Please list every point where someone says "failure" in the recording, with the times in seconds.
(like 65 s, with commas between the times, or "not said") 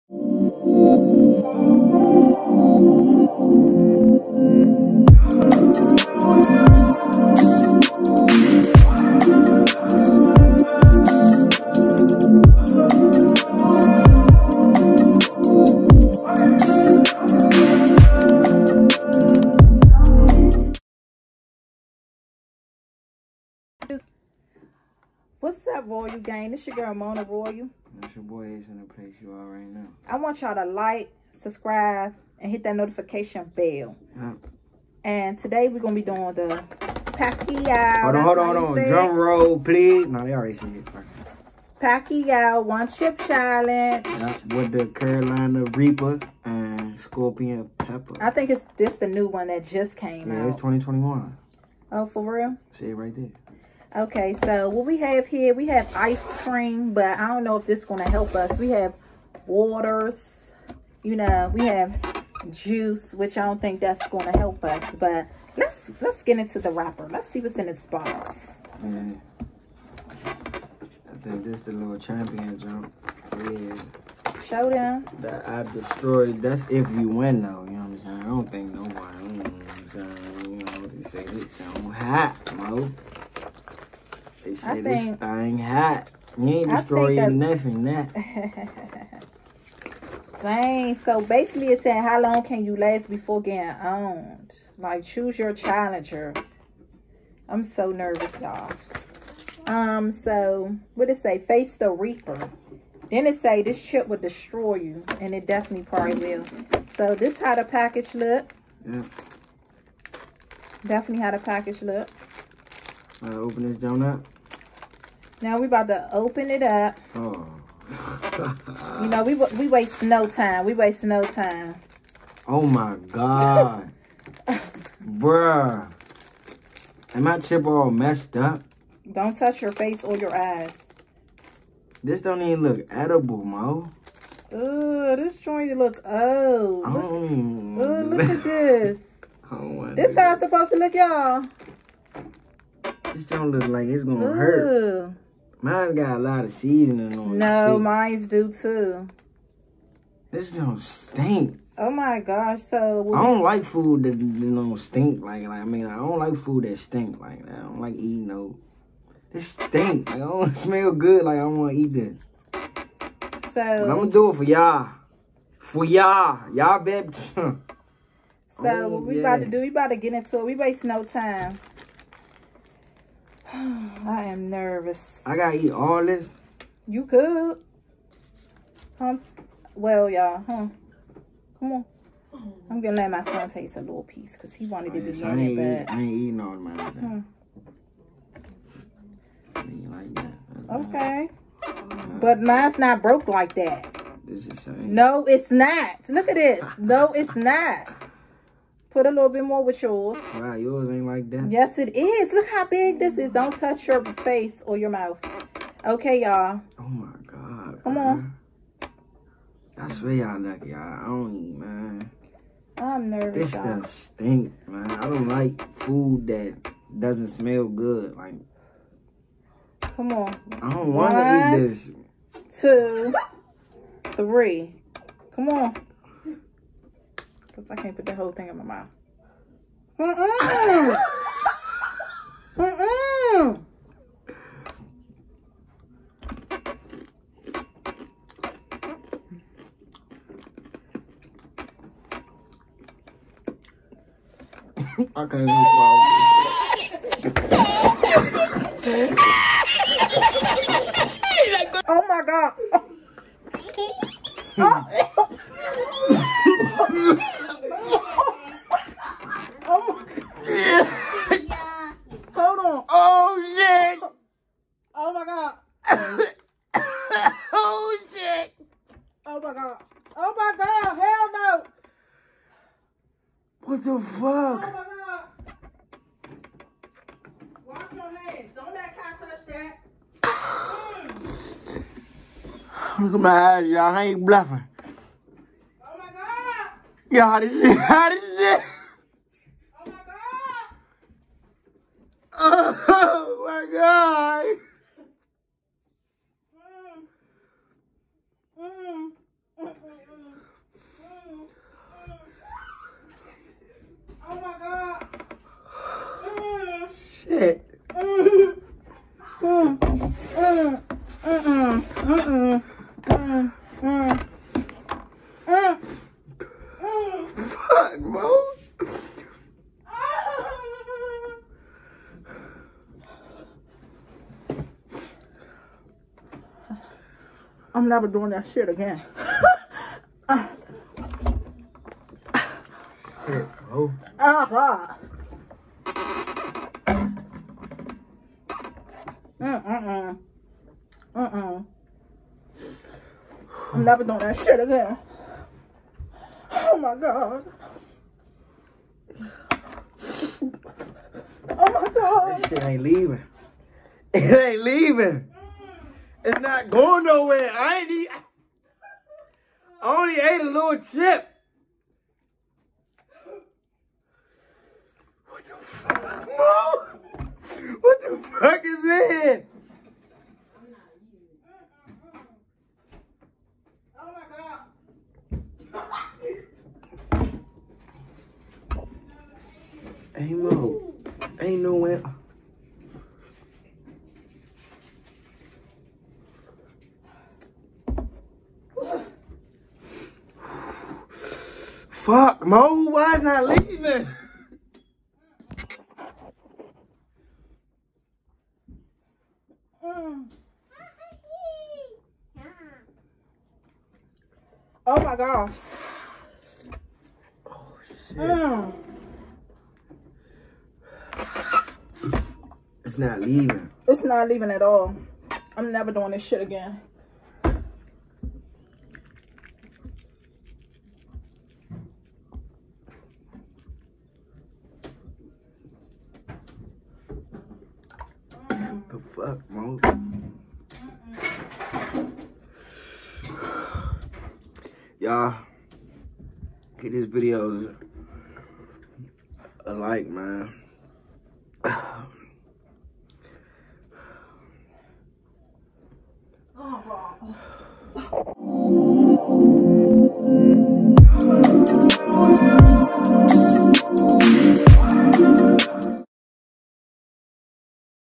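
not said.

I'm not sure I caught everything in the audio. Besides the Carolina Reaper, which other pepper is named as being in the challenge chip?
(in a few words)
Scorpion Pepper.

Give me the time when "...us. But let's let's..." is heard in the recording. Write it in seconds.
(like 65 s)
64 s.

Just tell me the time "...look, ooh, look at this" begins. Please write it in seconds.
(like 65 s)
137 s.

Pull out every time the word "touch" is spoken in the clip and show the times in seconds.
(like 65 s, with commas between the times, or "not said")
129 s, 203 s, 278 s.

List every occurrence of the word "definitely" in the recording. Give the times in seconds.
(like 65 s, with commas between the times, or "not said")
105 s, 110 s.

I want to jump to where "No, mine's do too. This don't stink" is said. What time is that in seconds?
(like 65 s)
147 s.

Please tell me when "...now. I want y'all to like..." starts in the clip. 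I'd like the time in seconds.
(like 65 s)
29 s.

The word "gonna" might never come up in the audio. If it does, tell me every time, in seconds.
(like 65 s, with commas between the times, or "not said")
35 s, 144 s, 163 s, 182 s.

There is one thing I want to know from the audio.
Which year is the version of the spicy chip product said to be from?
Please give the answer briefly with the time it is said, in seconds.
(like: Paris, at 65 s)
2021, at 50 s.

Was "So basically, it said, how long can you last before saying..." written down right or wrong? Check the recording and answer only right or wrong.
wrong.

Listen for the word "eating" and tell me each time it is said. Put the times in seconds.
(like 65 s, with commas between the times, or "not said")
157 s, 186 s.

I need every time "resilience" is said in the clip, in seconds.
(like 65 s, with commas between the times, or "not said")
not said.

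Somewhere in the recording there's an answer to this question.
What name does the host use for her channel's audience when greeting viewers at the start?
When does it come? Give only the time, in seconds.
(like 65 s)
25 s.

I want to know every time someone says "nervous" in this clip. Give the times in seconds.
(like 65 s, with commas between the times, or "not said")
97 s, 174 s, 213 s.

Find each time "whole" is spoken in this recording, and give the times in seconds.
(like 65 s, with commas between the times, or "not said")
228 s.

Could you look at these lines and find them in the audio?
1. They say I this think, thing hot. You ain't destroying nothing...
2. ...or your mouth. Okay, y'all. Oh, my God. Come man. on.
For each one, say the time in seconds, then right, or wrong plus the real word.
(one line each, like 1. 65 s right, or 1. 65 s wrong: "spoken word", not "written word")
1. 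84 s right
2. 204 s right.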